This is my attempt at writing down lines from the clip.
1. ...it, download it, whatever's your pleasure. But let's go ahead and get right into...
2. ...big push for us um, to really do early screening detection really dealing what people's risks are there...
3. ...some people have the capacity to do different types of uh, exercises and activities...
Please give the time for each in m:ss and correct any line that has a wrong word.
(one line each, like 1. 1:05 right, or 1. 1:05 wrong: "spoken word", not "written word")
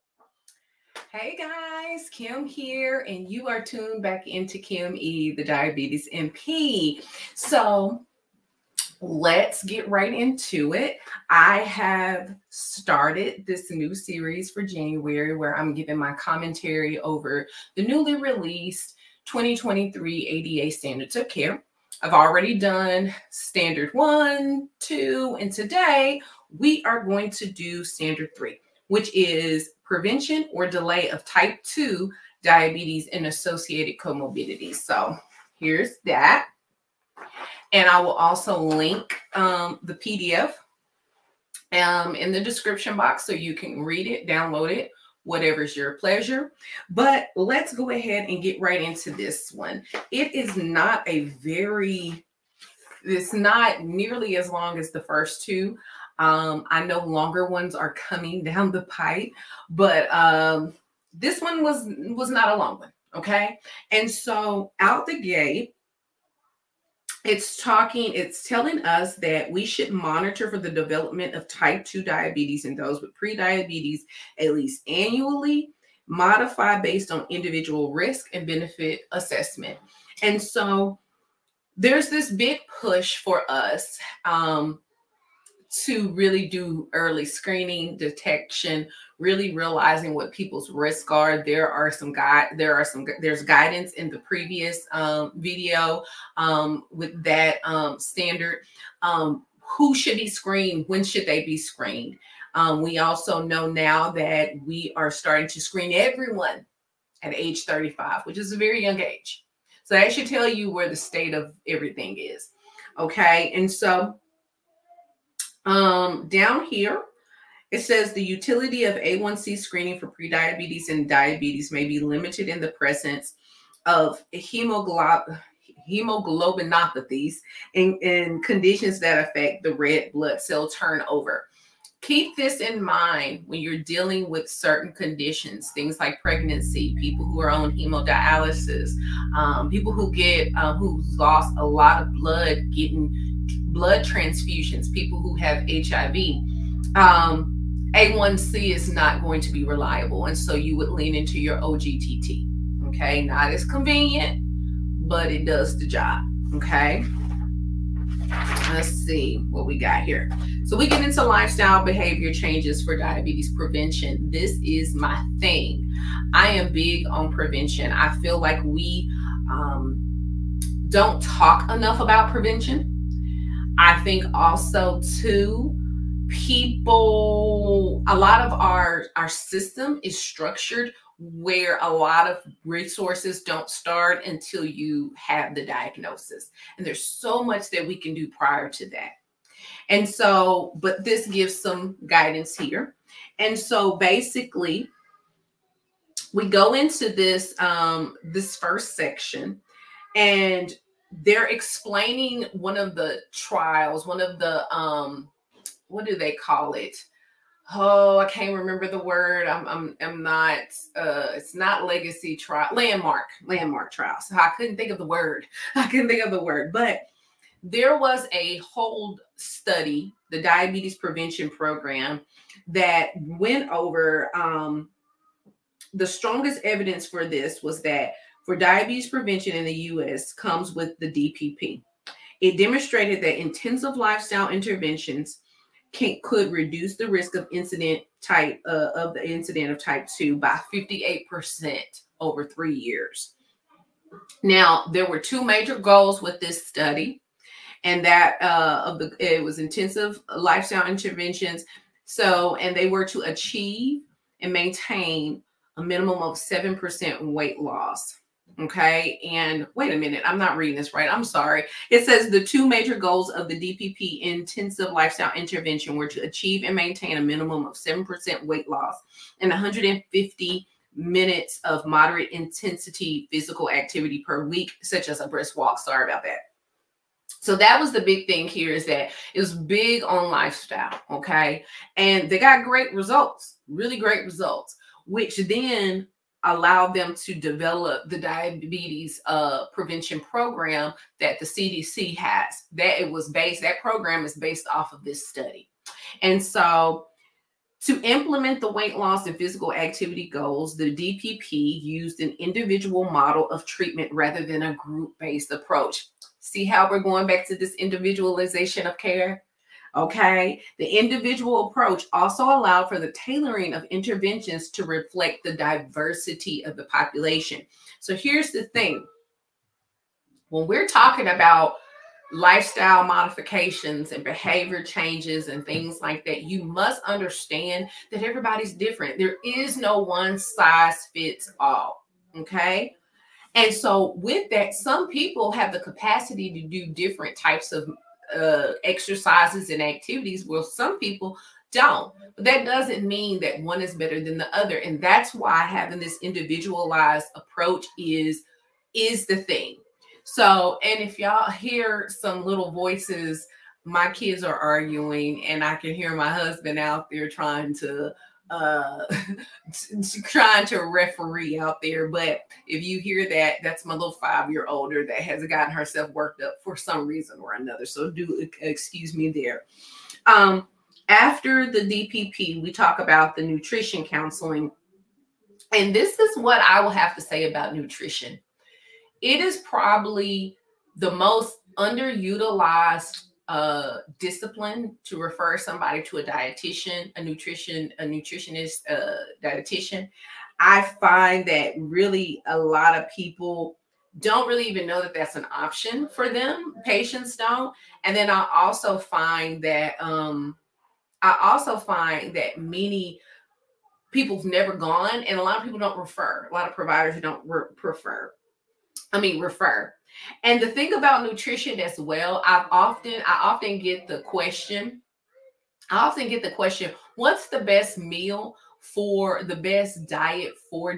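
1. 0:44 right
2. 1:22 wrong: "realizing", not "dealing"
3. 5:34 right.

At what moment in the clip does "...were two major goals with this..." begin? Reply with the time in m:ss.
4:05.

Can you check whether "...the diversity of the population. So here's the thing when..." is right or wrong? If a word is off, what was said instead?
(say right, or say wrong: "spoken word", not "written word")
right.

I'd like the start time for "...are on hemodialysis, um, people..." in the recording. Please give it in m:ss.
2:17.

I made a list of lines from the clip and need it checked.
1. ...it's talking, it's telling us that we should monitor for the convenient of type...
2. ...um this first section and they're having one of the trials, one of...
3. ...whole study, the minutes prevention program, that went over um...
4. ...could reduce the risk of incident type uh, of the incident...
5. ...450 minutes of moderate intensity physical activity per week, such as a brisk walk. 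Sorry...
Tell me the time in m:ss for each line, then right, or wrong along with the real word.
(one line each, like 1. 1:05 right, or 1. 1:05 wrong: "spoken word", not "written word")
1. 1:07 wrong: "development", not "convenient"
2. 3:17 wrong: "explaining", not "having"
3. 3:38 wrong: "diabetes", not "minutes"
4. 3:56 right
5. 4:29 wrong: "150", not "450".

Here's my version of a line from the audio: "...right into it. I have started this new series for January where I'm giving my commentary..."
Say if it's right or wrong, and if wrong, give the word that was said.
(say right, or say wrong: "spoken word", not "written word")
right.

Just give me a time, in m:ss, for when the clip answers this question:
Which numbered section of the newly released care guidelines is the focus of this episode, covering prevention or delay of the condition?
0:27.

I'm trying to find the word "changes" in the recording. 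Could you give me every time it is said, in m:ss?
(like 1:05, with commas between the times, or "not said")
2:42, 5:24.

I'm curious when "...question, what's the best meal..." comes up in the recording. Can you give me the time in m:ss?
6:56.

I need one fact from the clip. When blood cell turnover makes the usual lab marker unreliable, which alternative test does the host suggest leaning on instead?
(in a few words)
OGTT.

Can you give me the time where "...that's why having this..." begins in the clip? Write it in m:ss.
5:45.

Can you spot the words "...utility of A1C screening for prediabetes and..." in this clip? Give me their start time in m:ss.
1:58.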